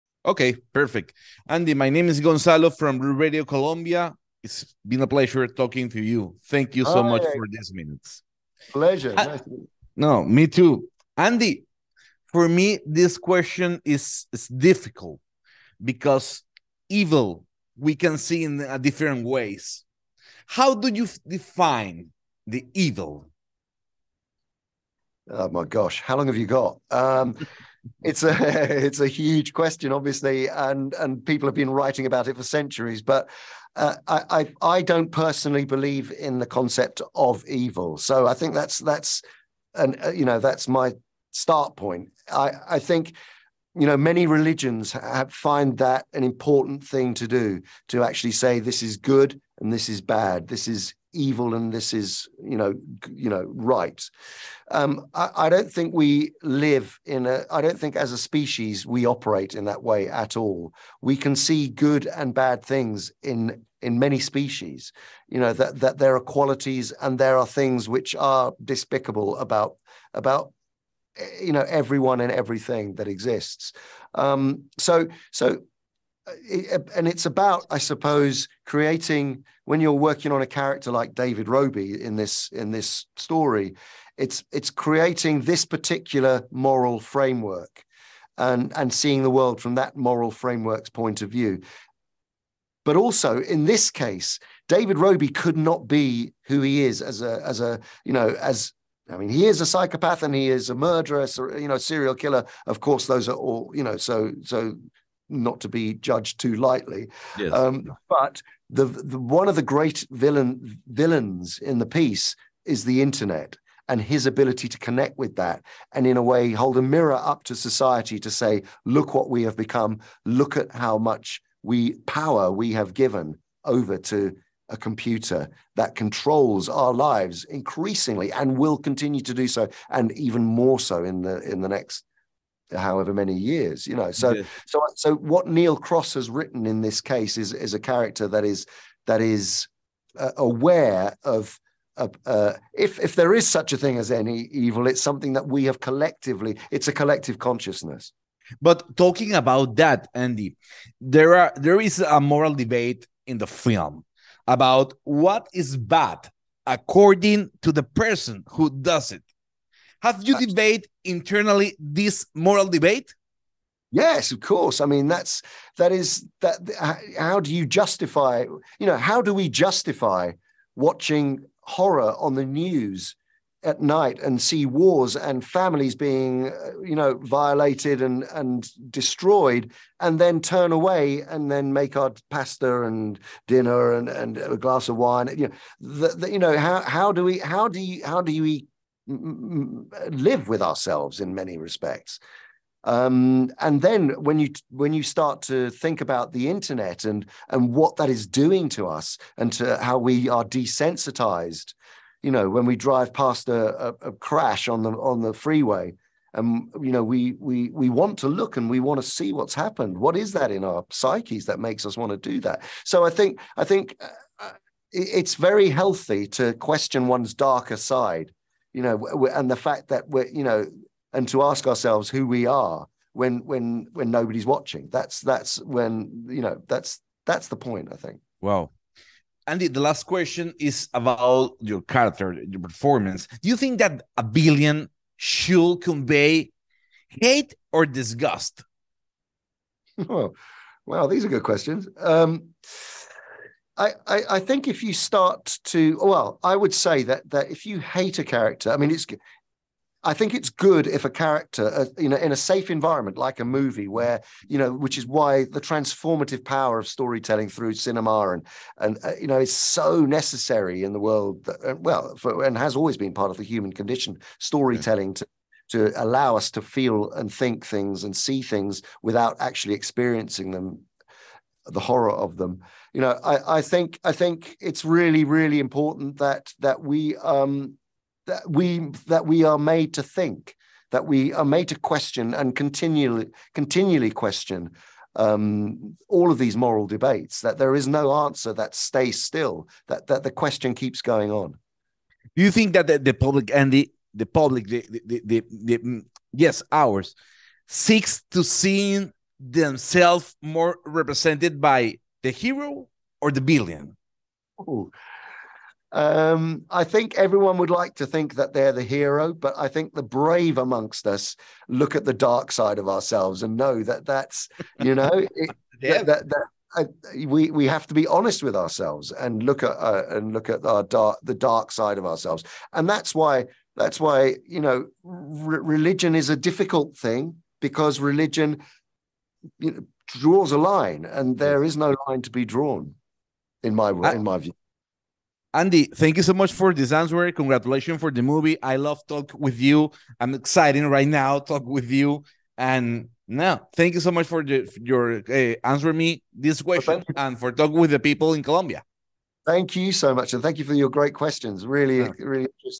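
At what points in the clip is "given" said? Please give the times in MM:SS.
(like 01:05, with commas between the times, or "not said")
02:02.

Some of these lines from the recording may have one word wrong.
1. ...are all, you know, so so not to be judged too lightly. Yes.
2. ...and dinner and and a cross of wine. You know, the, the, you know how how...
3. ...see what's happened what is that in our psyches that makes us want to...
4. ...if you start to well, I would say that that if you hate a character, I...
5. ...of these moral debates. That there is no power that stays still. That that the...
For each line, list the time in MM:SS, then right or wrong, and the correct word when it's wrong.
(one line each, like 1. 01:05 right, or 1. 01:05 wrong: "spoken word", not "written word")
1. 01:43 right
2. 03:02 wrong: "glass", not "cross"
3. 03:29 right
4. 04:04 right
5. 04:46 wrong: "answer", not "power".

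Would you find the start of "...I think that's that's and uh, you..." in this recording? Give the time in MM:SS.
00:38.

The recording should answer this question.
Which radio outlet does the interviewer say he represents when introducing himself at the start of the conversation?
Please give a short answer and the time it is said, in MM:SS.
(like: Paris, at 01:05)
Radio Colombia, at 00:02.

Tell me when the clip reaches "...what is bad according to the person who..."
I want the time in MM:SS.
02:35.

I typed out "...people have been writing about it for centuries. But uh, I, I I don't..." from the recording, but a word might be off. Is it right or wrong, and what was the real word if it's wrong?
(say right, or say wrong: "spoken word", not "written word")
right.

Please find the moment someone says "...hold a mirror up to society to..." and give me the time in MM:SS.
01:56.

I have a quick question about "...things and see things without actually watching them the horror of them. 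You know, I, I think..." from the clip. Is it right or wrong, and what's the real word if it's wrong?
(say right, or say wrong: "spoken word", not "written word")
wrong: "experiencing", not "watching".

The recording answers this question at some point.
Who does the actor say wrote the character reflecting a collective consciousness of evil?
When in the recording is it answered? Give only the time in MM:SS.
02:15.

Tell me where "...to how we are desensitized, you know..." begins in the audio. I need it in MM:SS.
03:19.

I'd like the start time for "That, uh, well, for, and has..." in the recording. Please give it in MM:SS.
04:21.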